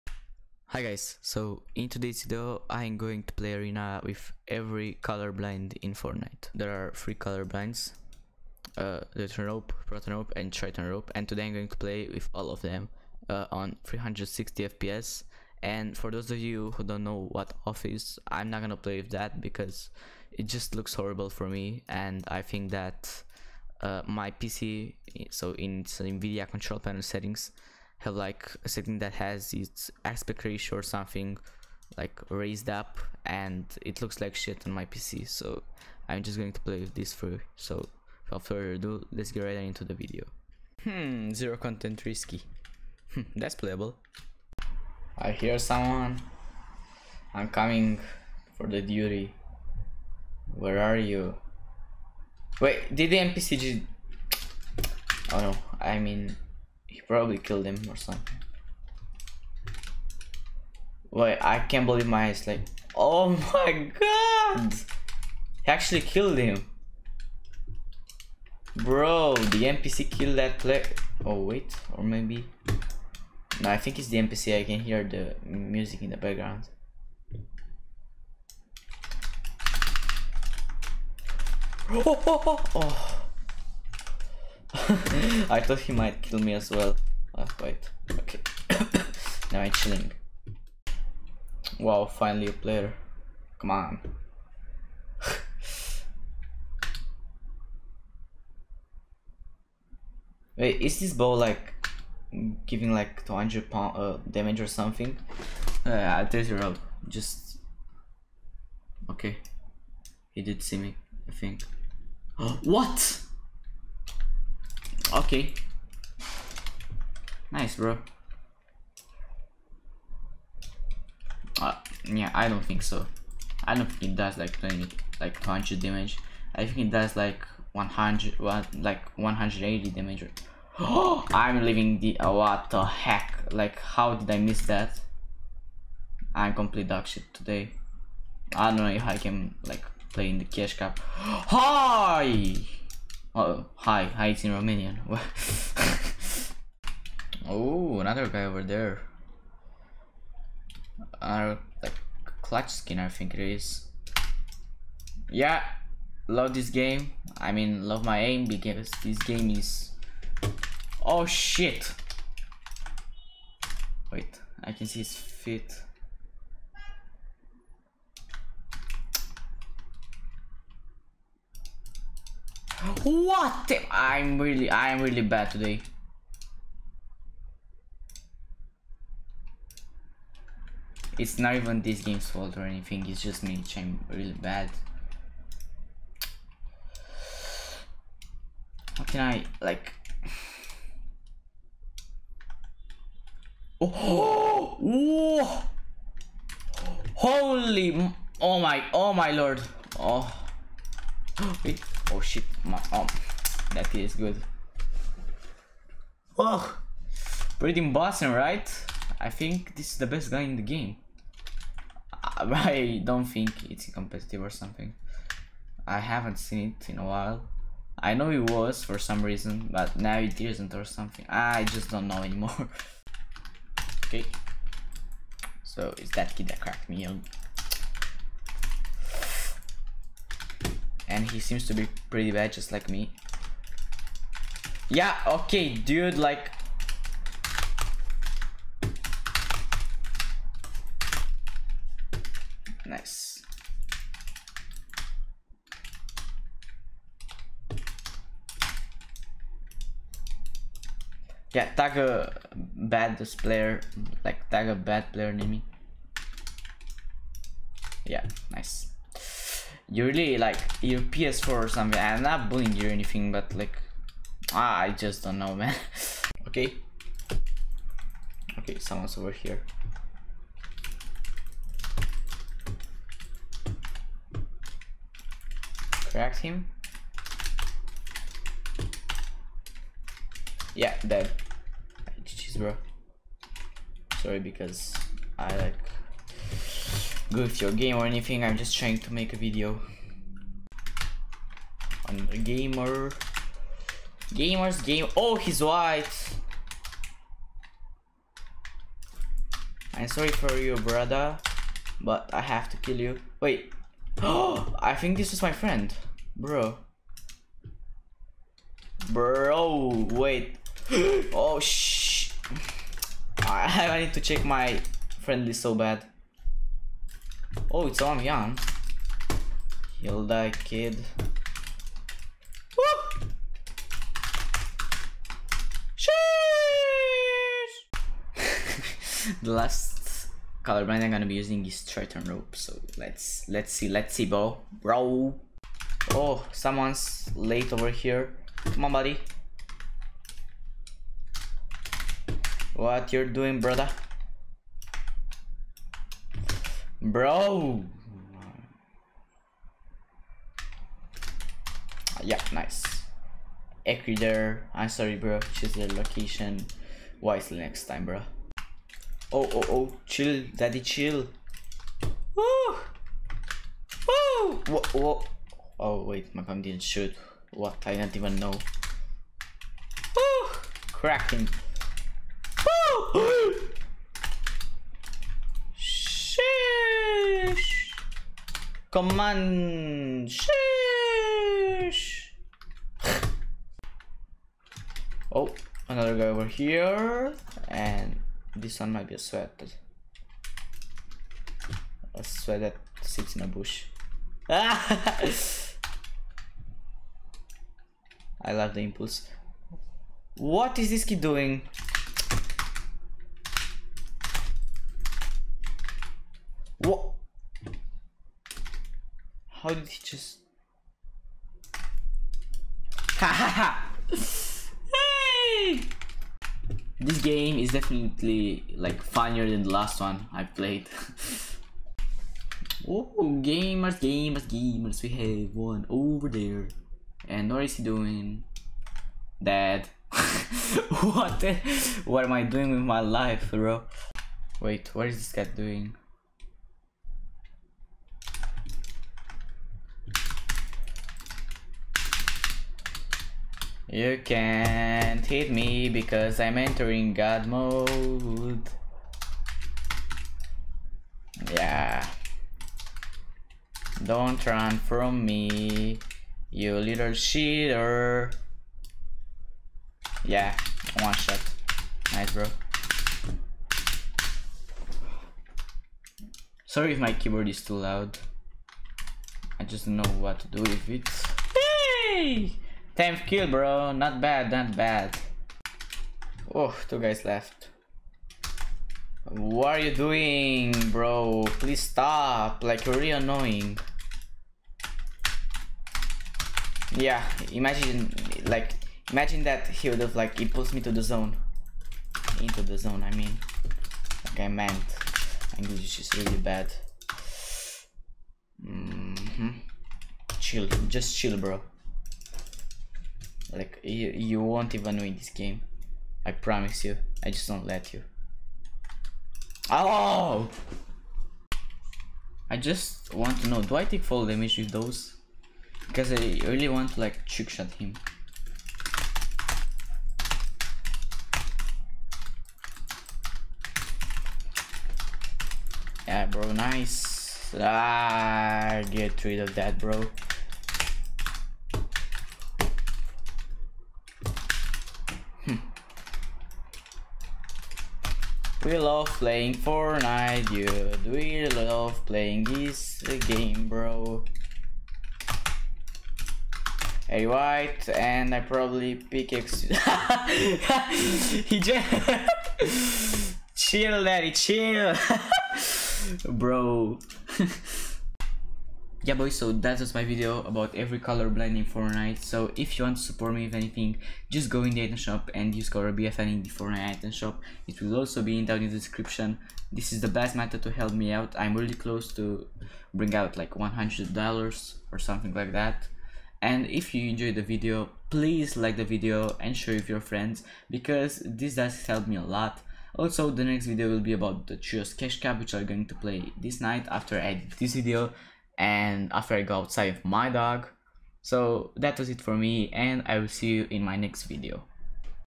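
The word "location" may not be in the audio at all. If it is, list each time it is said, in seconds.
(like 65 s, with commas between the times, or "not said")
355 s.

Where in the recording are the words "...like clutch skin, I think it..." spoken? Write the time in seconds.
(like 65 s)
151 s.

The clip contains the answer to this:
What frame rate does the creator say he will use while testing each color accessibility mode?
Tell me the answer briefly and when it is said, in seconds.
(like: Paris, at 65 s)
360 FPS, at 13 s.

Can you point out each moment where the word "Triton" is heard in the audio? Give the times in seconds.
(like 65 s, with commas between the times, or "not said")
10 s, 331 s.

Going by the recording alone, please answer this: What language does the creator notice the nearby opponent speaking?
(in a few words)
Romanian.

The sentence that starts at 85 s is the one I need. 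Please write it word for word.
I thought he might kill me as well.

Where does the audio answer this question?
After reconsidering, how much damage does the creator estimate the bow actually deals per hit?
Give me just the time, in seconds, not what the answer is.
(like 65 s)
129 s.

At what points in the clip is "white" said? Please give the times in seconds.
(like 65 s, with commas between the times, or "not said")
295 s, 547 s.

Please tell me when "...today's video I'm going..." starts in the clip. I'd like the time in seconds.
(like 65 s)
1 s.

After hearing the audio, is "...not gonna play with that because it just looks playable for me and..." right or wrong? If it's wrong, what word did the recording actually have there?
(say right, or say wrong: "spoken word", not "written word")
wrong: "horrible", not "playable".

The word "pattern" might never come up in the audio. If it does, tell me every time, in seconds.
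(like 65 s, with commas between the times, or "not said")
not said.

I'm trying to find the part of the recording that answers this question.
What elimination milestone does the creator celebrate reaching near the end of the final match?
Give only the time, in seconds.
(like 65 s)
472 s.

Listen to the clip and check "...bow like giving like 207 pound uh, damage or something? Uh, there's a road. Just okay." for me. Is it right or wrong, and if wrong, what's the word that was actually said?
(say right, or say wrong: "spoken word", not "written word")
wrong: "200", not "207".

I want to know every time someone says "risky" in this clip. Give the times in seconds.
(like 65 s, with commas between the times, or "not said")
42 s.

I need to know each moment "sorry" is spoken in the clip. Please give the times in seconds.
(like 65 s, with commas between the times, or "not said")
284 s, 300 s, 354 s, 466 s.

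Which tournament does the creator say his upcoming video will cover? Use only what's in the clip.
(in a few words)
Trios Cash Cup.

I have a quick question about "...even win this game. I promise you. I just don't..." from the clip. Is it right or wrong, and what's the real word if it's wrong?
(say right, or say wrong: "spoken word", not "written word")
right.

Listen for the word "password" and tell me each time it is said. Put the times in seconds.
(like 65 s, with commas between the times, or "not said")
not said.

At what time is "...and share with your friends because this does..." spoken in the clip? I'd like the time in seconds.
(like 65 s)
579 s.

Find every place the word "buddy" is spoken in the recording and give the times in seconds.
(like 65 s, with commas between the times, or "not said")
338 s.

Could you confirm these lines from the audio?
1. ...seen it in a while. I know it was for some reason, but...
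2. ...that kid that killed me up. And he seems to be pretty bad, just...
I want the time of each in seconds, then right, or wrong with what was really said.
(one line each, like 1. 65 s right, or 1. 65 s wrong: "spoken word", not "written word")
1. 216 s right
2. 226 s wrong: "cracked", not "killed".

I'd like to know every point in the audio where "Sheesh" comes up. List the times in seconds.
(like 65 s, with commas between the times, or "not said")
325 s, 375 s, 381 s.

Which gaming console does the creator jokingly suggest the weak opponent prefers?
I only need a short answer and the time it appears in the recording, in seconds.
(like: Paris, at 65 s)
PS4, at 260 s.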